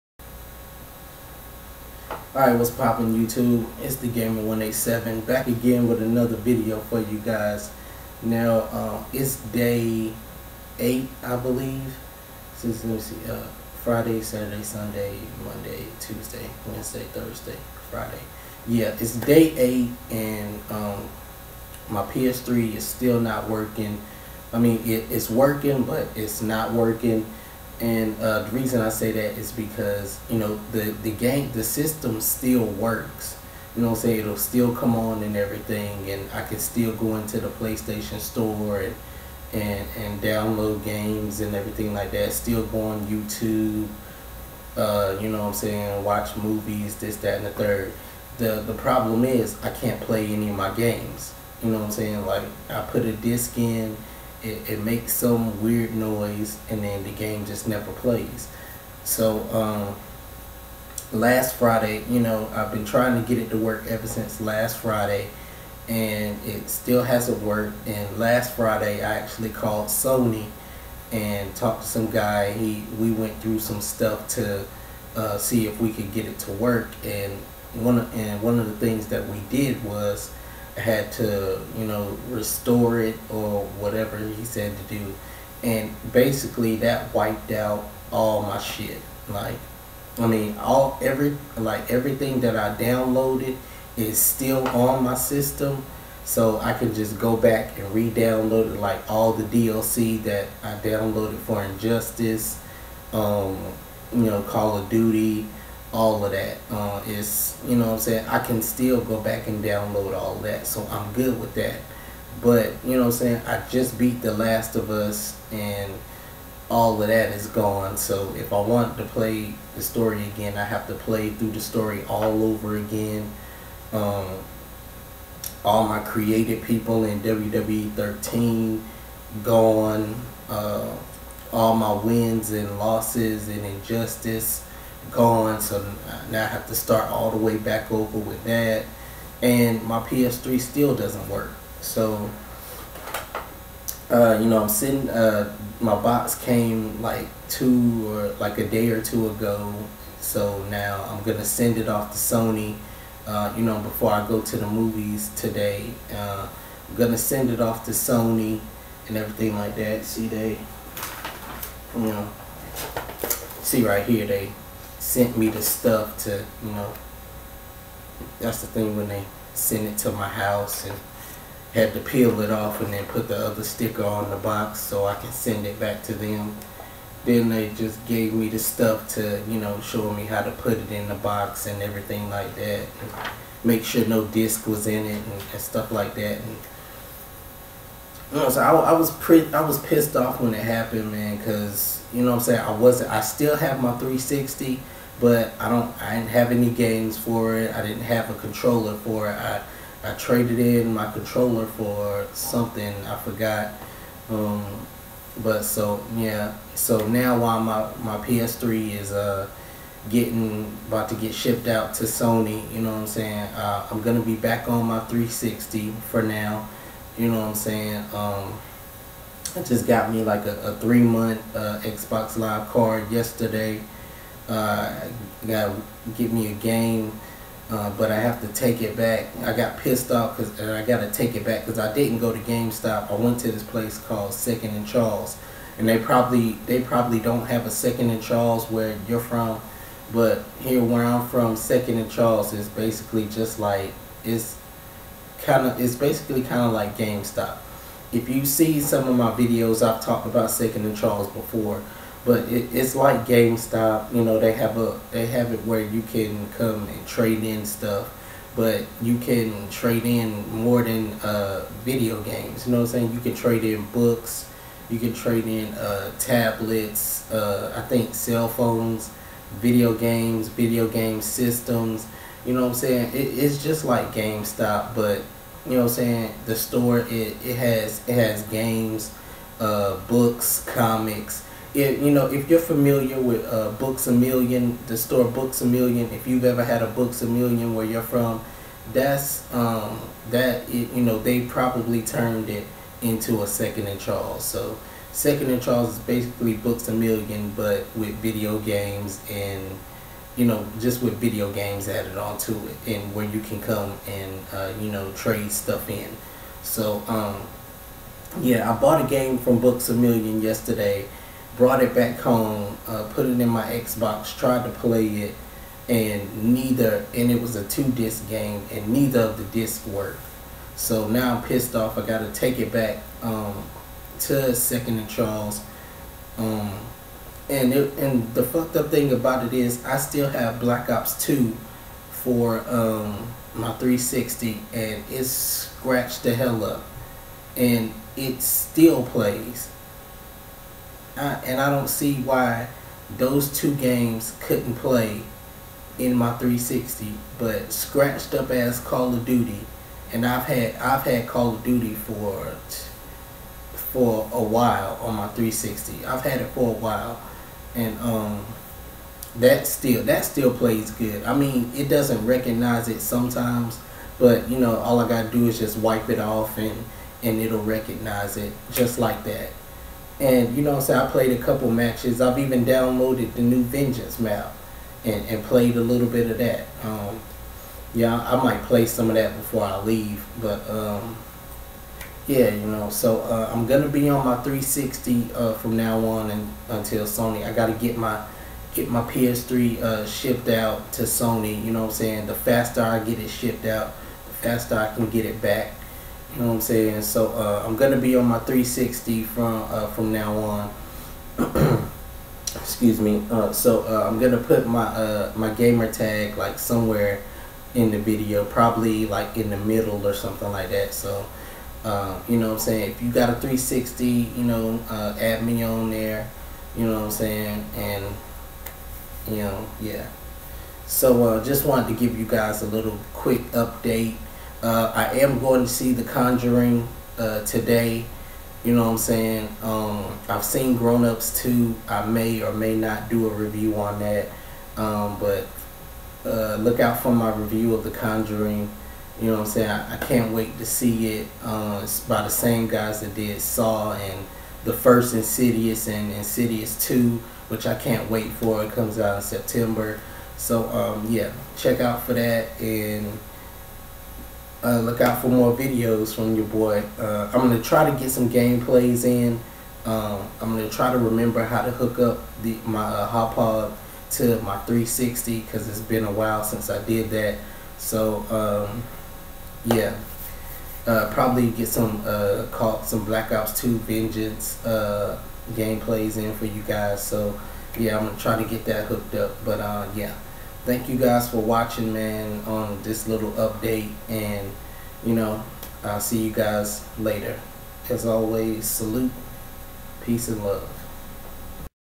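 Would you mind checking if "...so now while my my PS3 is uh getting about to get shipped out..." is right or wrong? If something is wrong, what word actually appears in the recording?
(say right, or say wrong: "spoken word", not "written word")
right.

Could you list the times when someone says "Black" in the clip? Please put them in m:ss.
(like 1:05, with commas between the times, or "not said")
5:30, 7:53.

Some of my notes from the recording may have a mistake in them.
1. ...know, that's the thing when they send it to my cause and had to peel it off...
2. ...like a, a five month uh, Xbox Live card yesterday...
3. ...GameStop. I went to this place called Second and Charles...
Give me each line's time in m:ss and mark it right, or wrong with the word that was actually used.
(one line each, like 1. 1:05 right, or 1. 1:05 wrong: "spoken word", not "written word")
1. 2:46 wrong: "house", not "cause"
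2. 3:40 wrong: "three", not "five"
3. 3:52 right.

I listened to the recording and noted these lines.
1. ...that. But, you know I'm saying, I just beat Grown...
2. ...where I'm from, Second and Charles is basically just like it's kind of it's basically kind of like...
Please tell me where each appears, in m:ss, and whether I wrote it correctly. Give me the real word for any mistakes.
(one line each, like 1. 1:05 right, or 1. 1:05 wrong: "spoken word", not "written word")
1. 1:51 wrong: "The", not "Grown"
2. 4:00 right.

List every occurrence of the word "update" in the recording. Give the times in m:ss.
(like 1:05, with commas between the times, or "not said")
7:03, 8:03.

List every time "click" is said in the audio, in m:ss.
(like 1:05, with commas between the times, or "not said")
not said.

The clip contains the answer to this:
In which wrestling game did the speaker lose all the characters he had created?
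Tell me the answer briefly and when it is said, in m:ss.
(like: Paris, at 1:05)
WWE 13, at 2:07.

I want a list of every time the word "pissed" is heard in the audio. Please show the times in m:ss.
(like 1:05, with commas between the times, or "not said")
3:09, 3:49, 5:21.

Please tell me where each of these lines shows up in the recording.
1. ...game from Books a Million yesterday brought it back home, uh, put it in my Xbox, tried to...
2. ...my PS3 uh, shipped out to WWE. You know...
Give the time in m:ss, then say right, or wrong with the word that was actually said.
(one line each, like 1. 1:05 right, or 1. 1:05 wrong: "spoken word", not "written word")
1. 5:09 right
2. 6:28 wrong: "Sony", not "WWE".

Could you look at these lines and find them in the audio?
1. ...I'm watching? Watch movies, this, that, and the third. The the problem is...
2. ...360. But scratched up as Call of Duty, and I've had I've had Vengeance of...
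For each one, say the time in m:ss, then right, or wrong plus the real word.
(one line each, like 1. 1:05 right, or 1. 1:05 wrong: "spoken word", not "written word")
1. 0:45 wrong: "saying", not "watching"
2. 5:46 wrong: "Call", not "Vengeance".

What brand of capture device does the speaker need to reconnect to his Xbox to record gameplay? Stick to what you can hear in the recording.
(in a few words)
Hauppauge.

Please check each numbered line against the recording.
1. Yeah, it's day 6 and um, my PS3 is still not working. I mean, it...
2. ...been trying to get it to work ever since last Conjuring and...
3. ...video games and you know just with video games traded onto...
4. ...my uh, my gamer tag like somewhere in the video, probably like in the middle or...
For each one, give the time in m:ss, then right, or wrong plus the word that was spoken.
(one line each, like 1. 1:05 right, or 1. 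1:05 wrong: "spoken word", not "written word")
1. 0:18 wrong: "8", not "6"
2. 1:02 wrong: "Friday", not "Conjuring"
3. 4:58 wrong: "added", not "traded"
4. 6:44 right.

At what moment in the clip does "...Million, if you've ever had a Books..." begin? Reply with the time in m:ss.
4:45.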